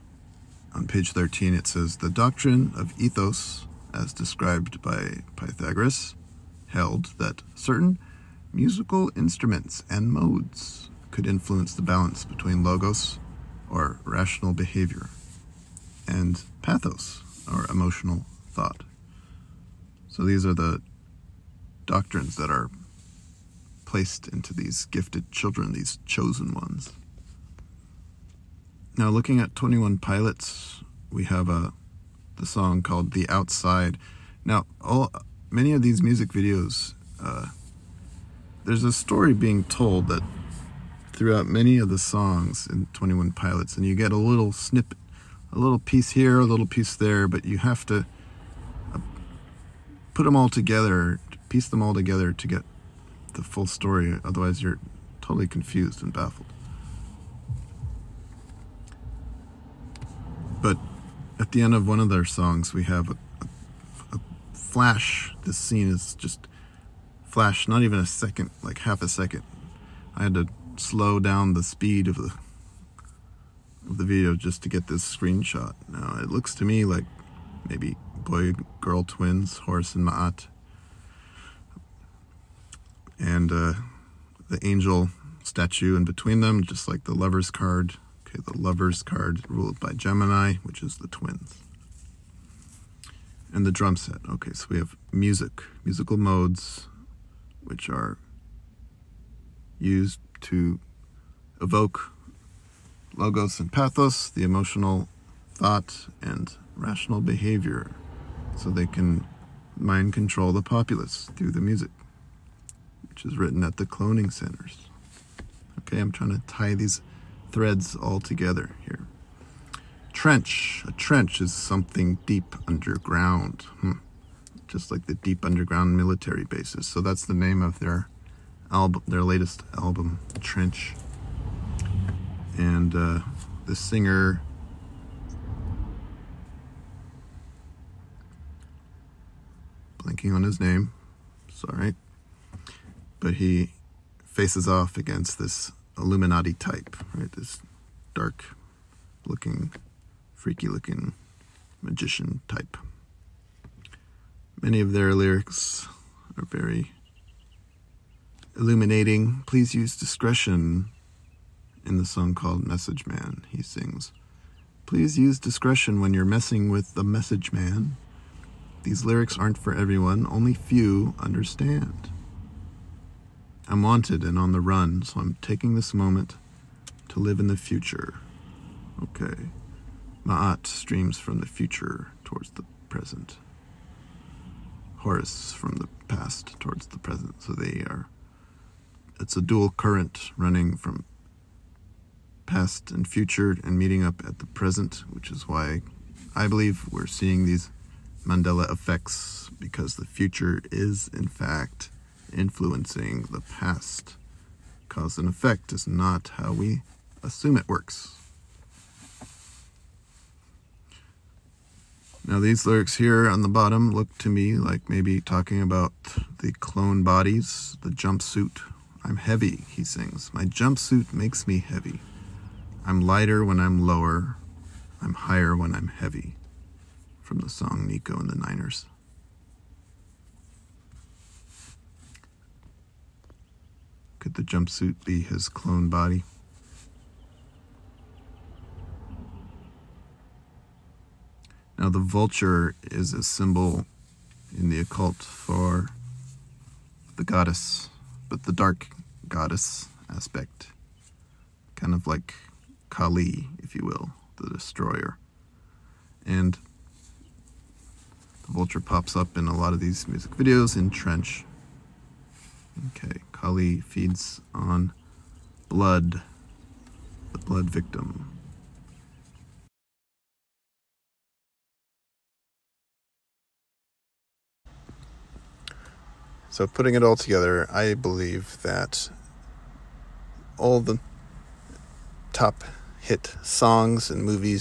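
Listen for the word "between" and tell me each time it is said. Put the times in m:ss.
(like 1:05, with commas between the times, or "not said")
0:12, 1:26.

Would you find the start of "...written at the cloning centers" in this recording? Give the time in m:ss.
1:53.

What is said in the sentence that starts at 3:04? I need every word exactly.
Horus from the past towards the present.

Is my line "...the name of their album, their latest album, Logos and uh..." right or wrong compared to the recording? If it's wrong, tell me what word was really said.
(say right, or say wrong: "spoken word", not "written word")
wrong: "Trench", not "Logos".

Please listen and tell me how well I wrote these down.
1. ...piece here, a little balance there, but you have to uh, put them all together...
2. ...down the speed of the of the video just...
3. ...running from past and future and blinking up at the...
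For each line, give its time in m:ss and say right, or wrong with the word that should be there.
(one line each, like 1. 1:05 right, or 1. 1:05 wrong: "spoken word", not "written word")
1. 0:45 wrong: "piece", not "balance"
2. 1:11 right
3. 3:10 wrong: "meeting", not "blinking".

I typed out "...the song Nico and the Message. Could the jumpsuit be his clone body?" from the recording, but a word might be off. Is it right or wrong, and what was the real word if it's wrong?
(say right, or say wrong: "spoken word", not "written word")
wrong: "Niners", not "Message".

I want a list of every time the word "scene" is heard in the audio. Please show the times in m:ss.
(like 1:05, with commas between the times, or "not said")
1:05.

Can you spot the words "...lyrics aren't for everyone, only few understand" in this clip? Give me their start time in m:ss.
2:49.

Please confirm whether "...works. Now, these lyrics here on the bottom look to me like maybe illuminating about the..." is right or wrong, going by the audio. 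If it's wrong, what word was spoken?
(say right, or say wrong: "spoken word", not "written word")
wrong: "talking", not "illuminating".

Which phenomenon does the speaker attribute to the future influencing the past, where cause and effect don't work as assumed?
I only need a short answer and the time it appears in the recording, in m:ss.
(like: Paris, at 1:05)
Mandela effects, at 3:18.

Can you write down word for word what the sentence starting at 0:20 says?
So these are the doctrines that are placed into these gifted children, these chosen ones.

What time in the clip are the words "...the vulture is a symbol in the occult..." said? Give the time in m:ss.
4:01.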